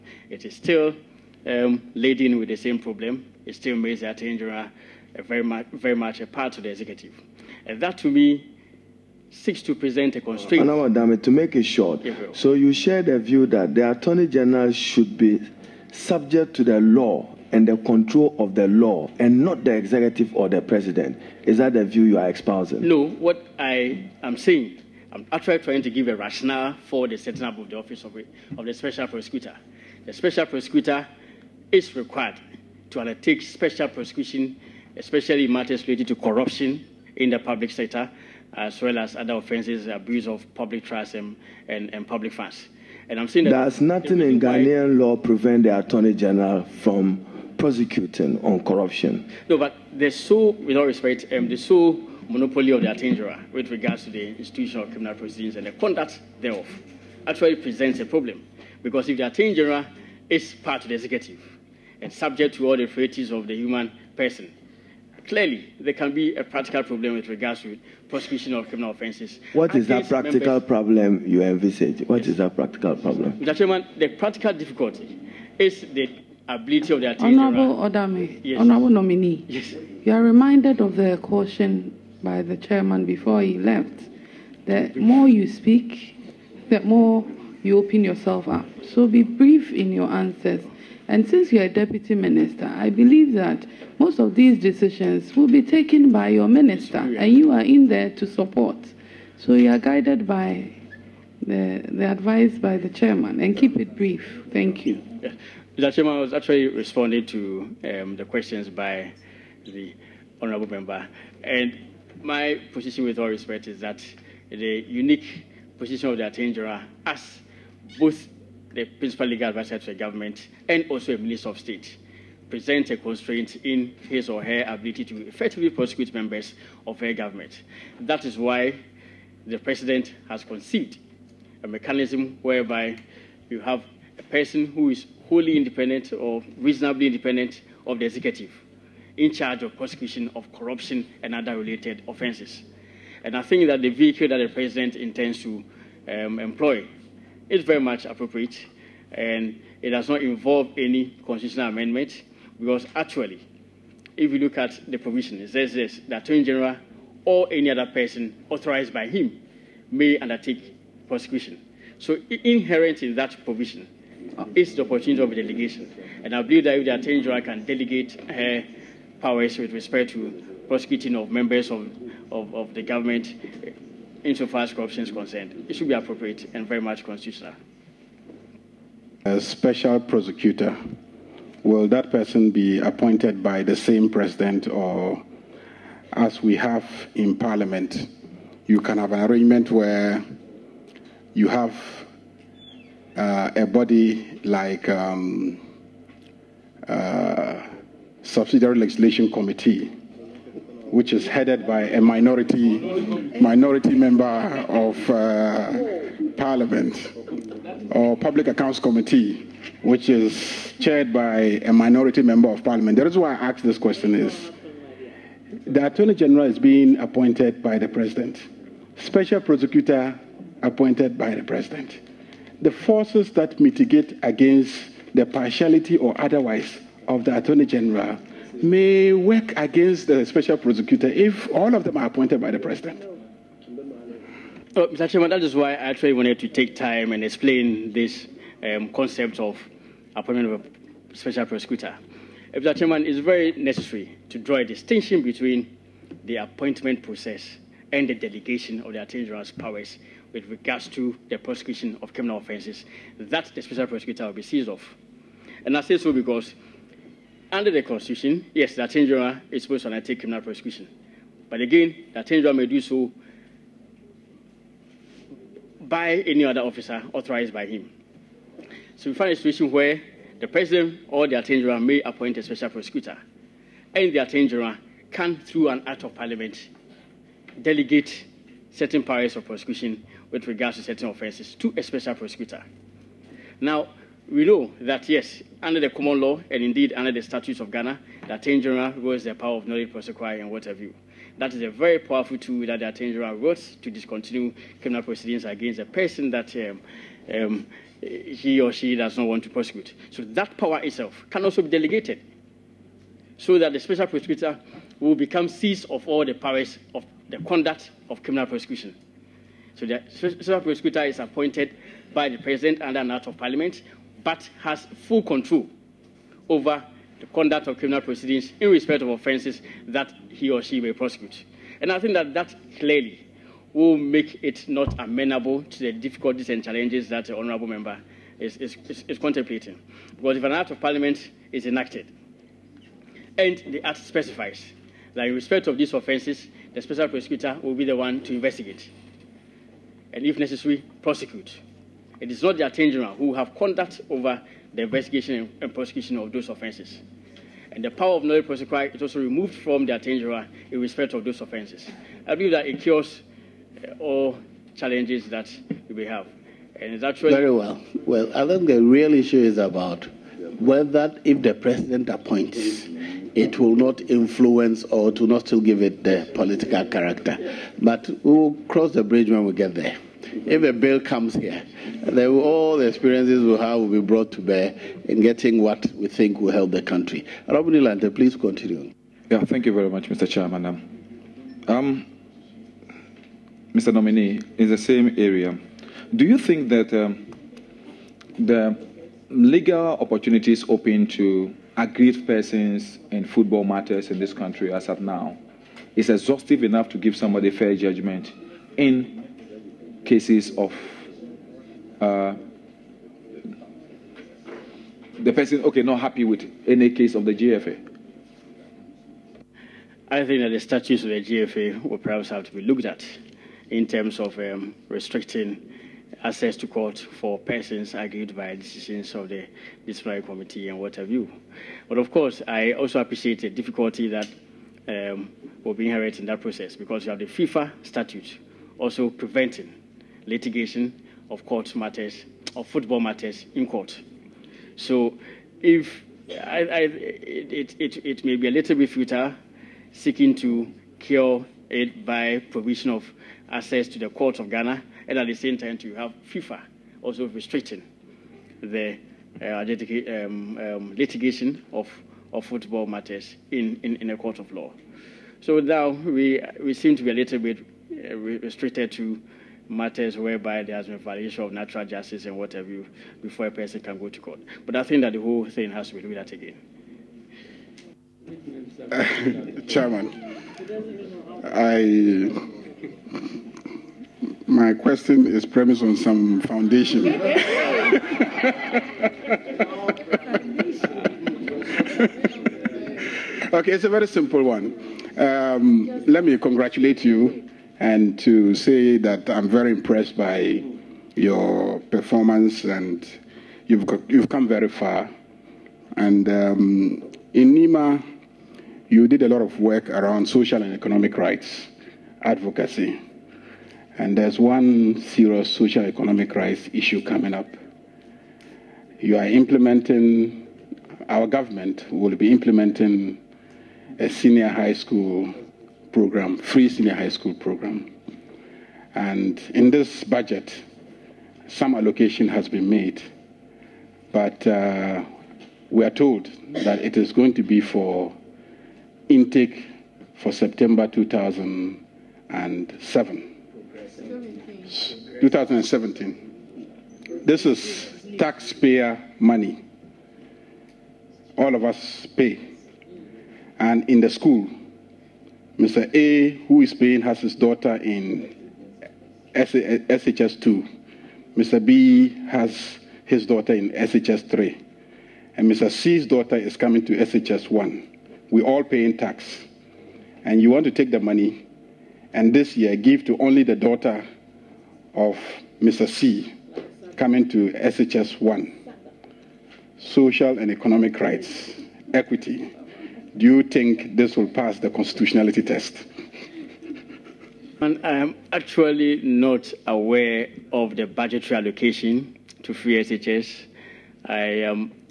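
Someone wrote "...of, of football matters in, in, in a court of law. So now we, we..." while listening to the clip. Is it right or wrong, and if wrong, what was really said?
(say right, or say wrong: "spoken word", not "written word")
right.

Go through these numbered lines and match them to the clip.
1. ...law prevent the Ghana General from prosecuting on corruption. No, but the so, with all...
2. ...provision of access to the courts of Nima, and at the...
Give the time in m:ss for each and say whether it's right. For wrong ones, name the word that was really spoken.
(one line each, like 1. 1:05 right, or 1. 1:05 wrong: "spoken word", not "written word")
1. 0:44 wrong: "Attorney", not "Ghana"
2. 7:22 wrong: "Ghana", not "Nima".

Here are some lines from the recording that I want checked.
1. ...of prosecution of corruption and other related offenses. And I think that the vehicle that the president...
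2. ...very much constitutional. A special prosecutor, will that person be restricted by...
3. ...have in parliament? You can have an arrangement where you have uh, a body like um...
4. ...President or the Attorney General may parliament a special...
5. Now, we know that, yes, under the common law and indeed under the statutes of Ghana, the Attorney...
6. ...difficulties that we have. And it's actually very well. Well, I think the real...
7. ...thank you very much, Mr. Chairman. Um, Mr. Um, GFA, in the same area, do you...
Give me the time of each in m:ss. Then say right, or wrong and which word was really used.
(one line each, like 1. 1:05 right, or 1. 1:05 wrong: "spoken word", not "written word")
1. 2:19 right
2. 2:56 wrong: "appointed", not "restricted"
3. 3:06 right
4. 4:30 wrong: "appoint", not "parliament"
5. 4:43 right
6. 5:54 wrong: "challenges", not "difficulties"
7. 6:19 wrong: "Nominee", not "GFA".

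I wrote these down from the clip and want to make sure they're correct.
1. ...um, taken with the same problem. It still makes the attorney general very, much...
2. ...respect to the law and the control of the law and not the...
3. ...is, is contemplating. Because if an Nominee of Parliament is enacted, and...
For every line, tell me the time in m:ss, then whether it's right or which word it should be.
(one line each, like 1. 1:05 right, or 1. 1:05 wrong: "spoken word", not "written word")
1. 0:01 wrong: "laden", not "taken"
2. 0:15 wrong: "subject", not "respect"
3. 5:28 wrong: "Act", not "Nominee".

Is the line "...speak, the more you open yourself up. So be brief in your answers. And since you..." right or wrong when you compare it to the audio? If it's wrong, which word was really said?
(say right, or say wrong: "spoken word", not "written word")
right.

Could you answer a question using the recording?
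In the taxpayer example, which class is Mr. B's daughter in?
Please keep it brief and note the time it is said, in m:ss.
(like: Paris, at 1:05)
SHS3, at 9:13.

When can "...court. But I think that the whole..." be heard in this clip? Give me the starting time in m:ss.
7:44.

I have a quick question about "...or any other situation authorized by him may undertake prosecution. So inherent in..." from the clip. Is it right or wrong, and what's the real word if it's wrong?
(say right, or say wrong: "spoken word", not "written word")
wrong: "person", not "situation".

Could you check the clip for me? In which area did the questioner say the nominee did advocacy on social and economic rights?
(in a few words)
Nima.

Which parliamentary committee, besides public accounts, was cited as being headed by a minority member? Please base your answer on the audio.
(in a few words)
Subsidiary legislation committee.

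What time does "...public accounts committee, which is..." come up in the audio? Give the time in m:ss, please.
3:28.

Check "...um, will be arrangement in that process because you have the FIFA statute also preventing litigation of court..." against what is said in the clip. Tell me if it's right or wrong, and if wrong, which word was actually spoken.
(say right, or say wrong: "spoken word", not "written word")
wrong: "inherent", not "arrangement".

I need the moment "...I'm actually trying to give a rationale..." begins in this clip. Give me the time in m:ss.
0:25.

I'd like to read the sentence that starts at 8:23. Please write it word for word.
And there's one serious social economic rights issue coming up.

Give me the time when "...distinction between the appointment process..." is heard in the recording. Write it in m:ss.
4:04.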